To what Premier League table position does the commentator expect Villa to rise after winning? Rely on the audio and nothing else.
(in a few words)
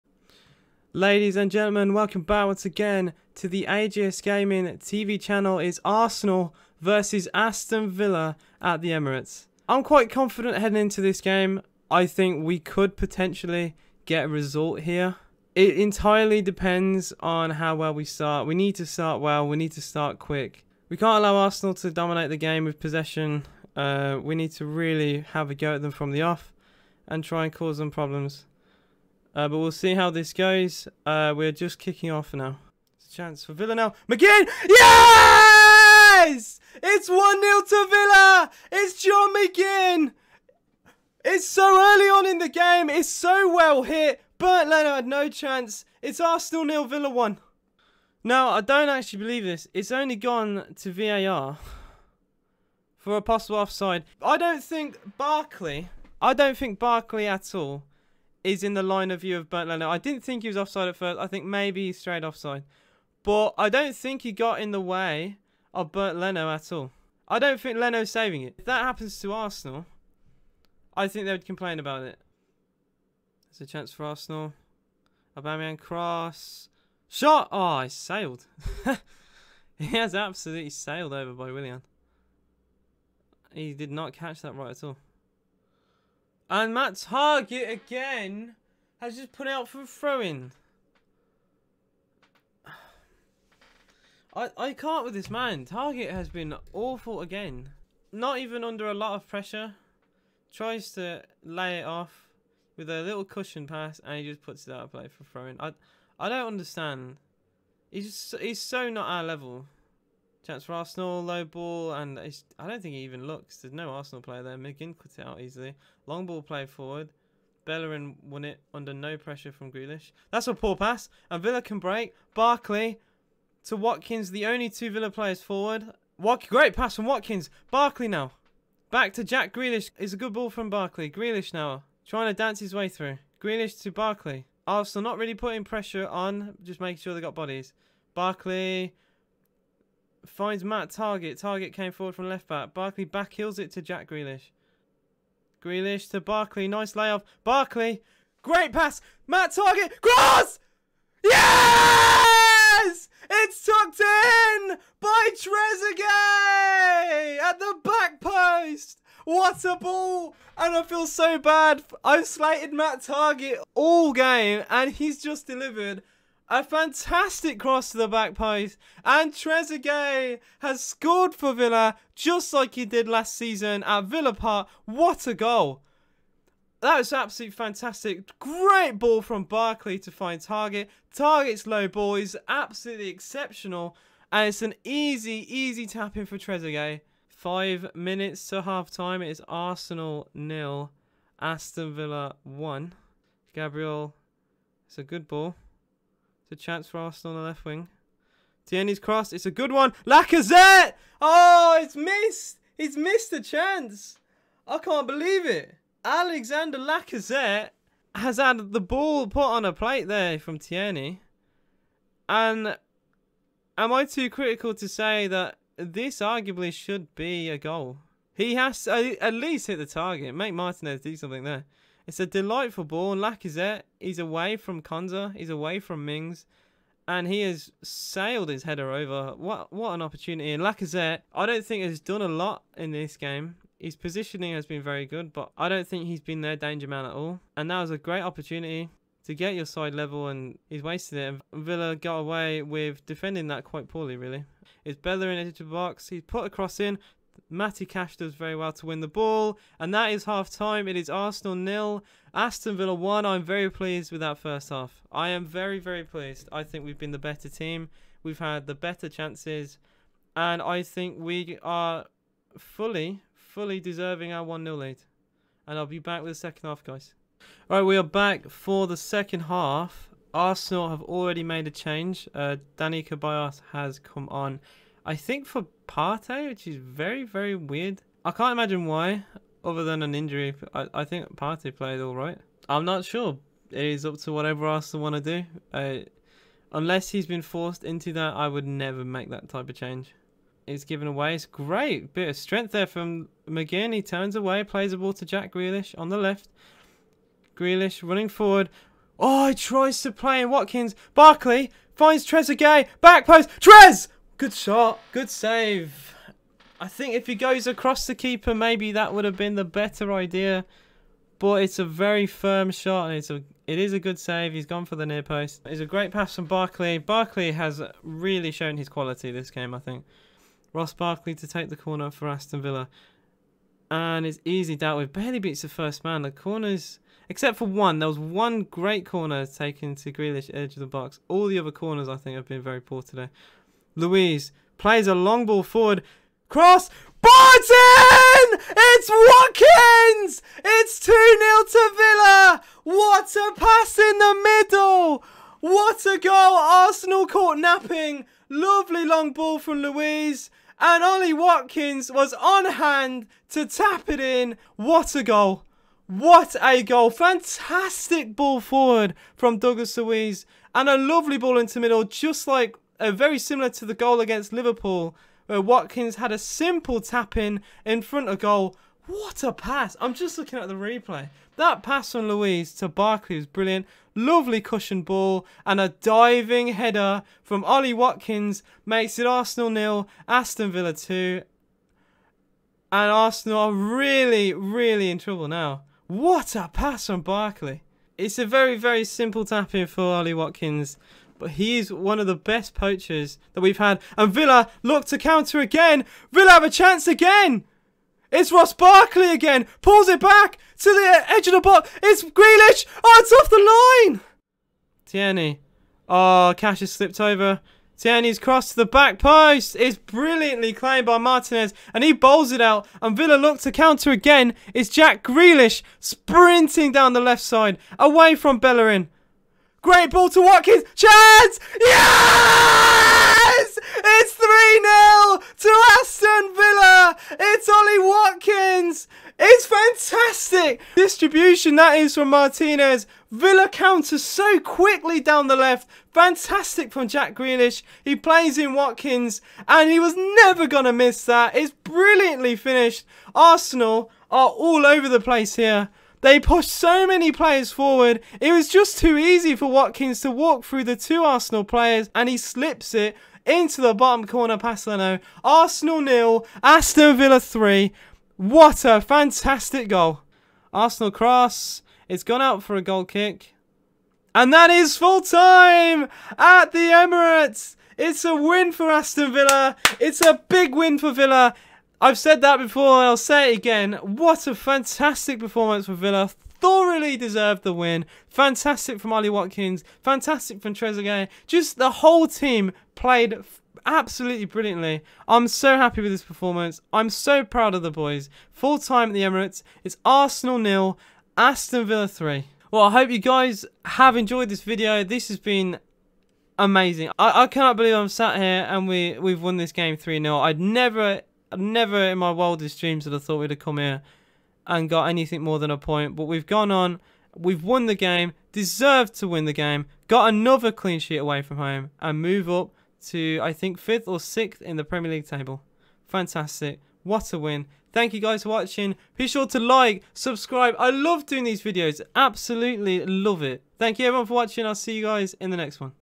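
5th or 6th.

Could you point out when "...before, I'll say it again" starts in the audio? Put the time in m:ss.
7:52.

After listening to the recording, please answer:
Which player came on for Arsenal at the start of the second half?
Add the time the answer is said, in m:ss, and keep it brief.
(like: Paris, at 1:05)
Dani Ceballos, at 4:32.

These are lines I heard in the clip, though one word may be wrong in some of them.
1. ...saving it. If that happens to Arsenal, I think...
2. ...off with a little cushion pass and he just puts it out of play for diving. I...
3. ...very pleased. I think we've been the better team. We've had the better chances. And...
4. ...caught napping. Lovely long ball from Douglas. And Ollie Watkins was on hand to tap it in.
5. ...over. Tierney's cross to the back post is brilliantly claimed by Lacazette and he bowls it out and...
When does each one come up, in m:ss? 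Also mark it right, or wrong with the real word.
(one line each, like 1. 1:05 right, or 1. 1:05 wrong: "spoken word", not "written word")
1. 1:08 right
2. 1:41 wrong: "throwing", not "diving"
3. 4:15 right
4. 5:47 wrong: "Luiz", not "Douglas"
5. 6:47 wrong: "Martinez", not "Lacazette".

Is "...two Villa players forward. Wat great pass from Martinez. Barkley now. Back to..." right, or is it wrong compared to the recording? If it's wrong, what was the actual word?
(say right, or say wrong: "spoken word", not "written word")
wrong: "Watkins", not "Martinez".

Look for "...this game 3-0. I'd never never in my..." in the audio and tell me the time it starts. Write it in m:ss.
8:19.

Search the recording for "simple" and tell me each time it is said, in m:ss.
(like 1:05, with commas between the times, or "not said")
6:06, 6:29.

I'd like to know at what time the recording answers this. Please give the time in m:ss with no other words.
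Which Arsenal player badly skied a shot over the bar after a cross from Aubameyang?
1:21.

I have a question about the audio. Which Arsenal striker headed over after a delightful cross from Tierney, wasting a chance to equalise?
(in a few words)
Alexander Lacazette.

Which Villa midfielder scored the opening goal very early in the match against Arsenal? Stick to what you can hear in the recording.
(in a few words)
John McGinn.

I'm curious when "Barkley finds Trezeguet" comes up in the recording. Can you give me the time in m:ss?
5:01.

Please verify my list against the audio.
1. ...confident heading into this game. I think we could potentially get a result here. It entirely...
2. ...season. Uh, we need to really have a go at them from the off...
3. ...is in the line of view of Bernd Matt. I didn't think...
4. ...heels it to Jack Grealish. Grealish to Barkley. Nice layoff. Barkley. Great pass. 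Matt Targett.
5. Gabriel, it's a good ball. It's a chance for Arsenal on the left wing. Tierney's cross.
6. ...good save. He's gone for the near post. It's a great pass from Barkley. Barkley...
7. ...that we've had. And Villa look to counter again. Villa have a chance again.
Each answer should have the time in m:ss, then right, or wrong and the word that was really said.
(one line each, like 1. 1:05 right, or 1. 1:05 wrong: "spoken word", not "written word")
1. 0:10 right
2. 0:22 wrong: "possession", not "season"
3. 0:58 wrong: "Leno", not "Matt"
4. 2:23 right
5. 3:13 right
6. 5:13 right
7. 6:33 right.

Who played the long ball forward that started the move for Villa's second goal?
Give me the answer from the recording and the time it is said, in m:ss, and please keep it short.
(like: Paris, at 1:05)
Douglas Luiz, at 5:59.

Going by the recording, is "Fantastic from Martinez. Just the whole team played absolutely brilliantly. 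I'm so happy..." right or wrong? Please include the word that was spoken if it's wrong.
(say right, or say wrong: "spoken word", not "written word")
wrong: "Trezeguet", not "Martinez".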